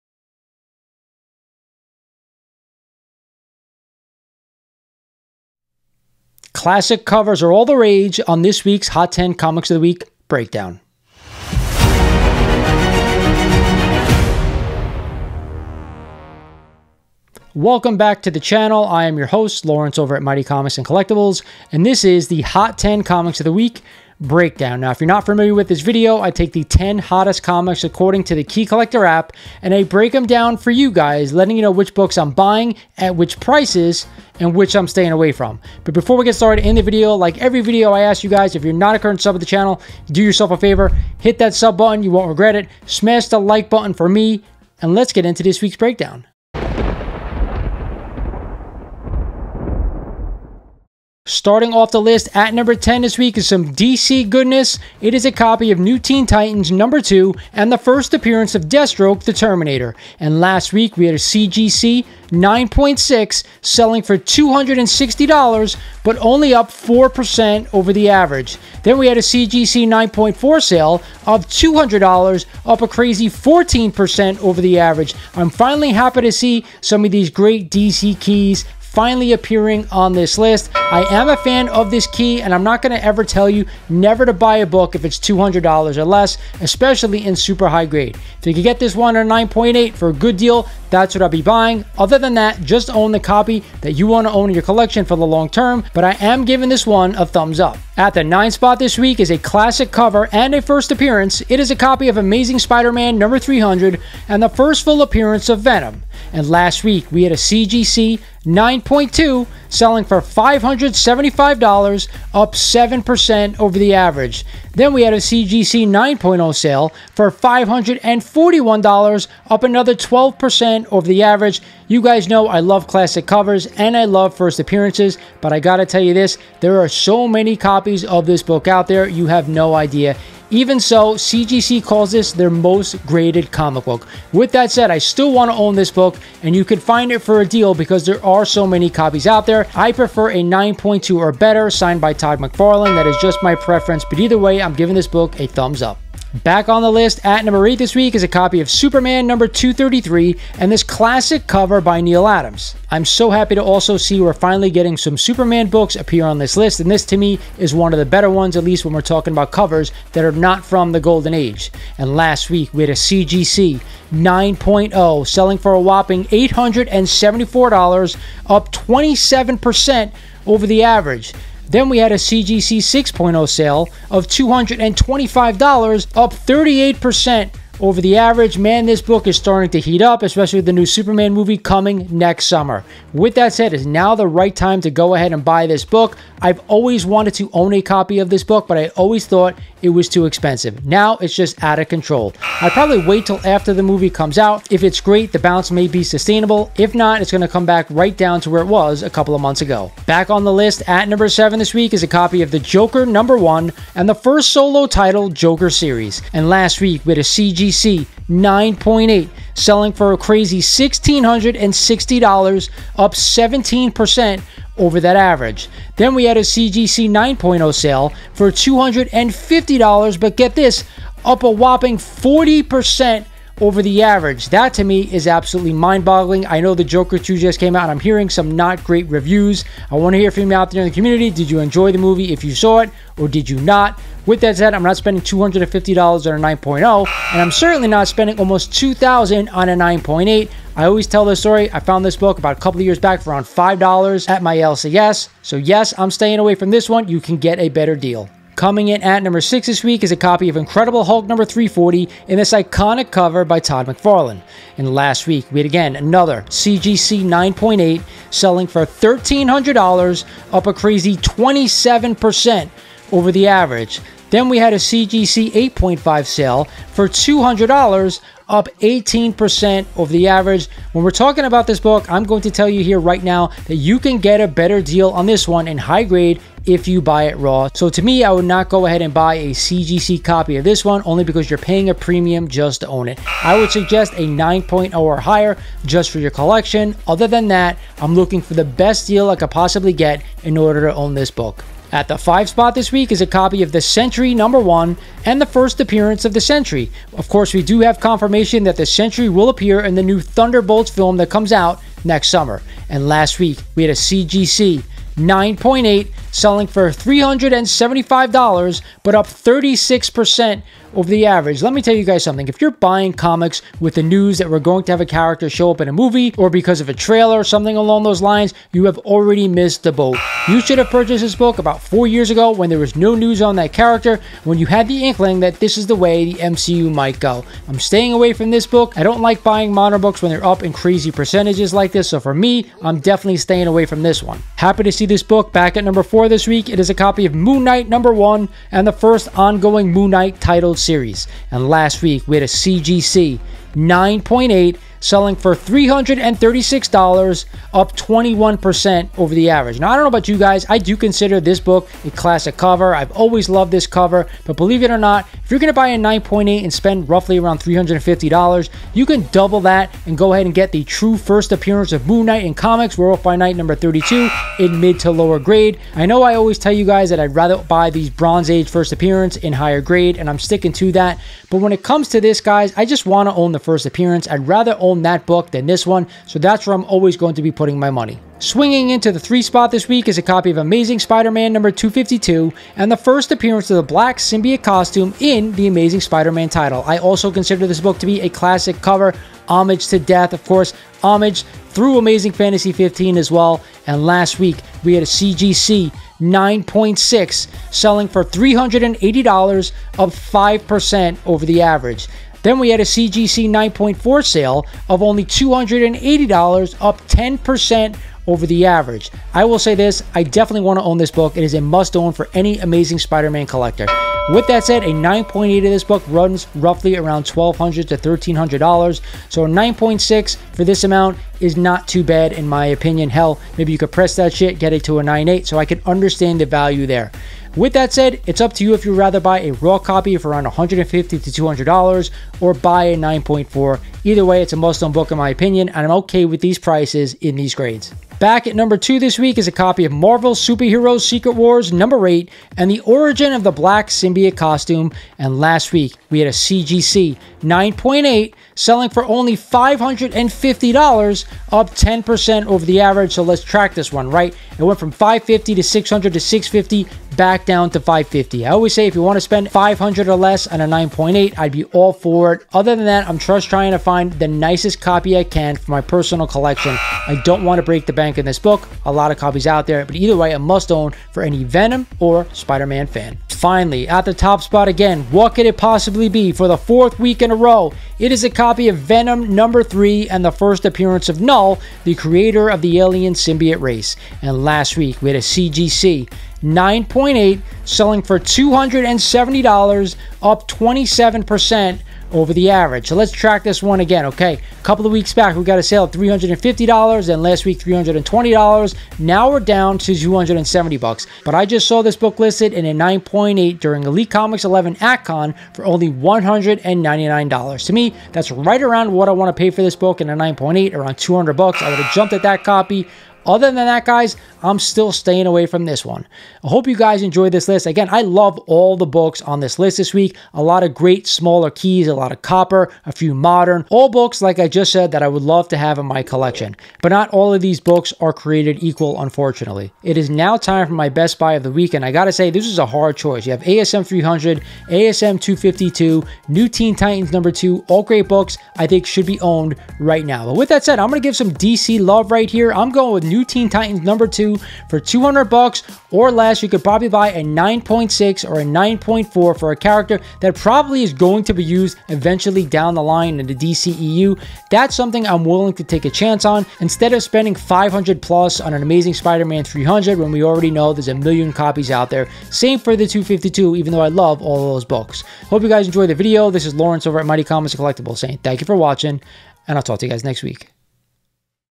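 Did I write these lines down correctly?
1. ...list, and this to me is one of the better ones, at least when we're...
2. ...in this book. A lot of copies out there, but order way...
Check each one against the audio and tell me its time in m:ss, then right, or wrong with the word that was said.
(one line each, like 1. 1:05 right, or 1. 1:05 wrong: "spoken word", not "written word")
1. 2:36 right
2. 7:48 wrong: "either", not "order".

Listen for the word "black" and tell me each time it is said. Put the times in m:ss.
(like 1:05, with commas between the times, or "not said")
6:23, 7:23.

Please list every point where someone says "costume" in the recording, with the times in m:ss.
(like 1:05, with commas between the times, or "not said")
6:24, 7:24.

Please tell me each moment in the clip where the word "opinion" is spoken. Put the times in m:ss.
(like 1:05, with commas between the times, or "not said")
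7:02, 7:15.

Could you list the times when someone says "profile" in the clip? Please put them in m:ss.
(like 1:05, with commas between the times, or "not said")
not said.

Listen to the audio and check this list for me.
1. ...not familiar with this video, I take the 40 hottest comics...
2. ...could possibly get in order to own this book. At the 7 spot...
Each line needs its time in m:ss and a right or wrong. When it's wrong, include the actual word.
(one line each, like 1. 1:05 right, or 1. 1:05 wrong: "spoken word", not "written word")
1. 0:25 wrong: "10", not "40"
2. 4:49 wrong: "5", not "7".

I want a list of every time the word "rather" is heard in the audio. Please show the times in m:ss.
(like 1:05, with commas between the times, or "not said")
6:07, 6:14, 7:08.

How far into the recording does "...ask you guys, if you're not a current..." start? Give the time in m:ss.
0:38.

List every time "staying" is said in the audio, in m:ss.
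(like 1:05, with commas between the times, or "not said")
0:34, 4:06, 5:27, 5:33, 8:34.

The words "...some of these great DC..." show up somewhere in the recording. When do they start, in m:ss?
1:16.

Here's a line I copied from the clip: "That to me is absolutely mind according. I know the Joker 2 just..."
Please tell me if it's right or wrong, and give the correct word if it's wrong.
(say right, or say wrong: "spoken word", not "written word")
wrong: "boggling", not "according".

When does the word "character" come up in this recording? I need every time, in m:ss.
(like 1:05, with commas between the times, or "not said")
5:15, 5:23, 9:09.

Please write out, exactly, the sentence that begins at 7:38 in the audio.
I always say if you want to spend 500 or less on a 9.8, I'd be all for it.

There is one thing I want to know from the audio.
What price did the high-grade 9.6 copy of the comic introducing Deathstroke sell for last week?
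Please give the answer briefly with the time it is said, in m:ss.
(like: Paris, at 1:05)
$260, at 1:04.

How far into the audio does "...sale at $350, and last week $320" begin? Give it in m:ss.
8:15.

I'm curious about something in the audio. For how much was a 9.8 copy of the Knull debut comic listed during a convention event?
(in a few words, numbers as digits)
$199.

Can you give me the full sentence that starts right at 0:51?
Starting off the list at number 10 this week is some DC goodness.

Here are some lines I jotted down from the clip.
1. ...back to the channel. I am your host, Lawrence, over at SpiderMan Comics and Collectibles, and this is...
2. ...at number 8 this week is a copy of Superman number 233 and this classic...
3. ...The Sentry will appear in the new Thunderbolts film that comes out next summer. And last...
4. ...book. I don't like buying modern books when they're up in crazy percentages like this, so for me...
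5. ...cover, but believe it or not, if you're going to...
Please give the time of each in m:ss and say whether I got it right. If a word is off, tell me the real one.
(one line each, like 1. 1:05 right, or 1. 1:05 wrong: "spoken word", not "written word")
1. 0:17 wrong: "Mighty", not "SpiderMan"
2. 2:27 right
3. 4:58 right
4. 5:28 right
5. 5:53 right.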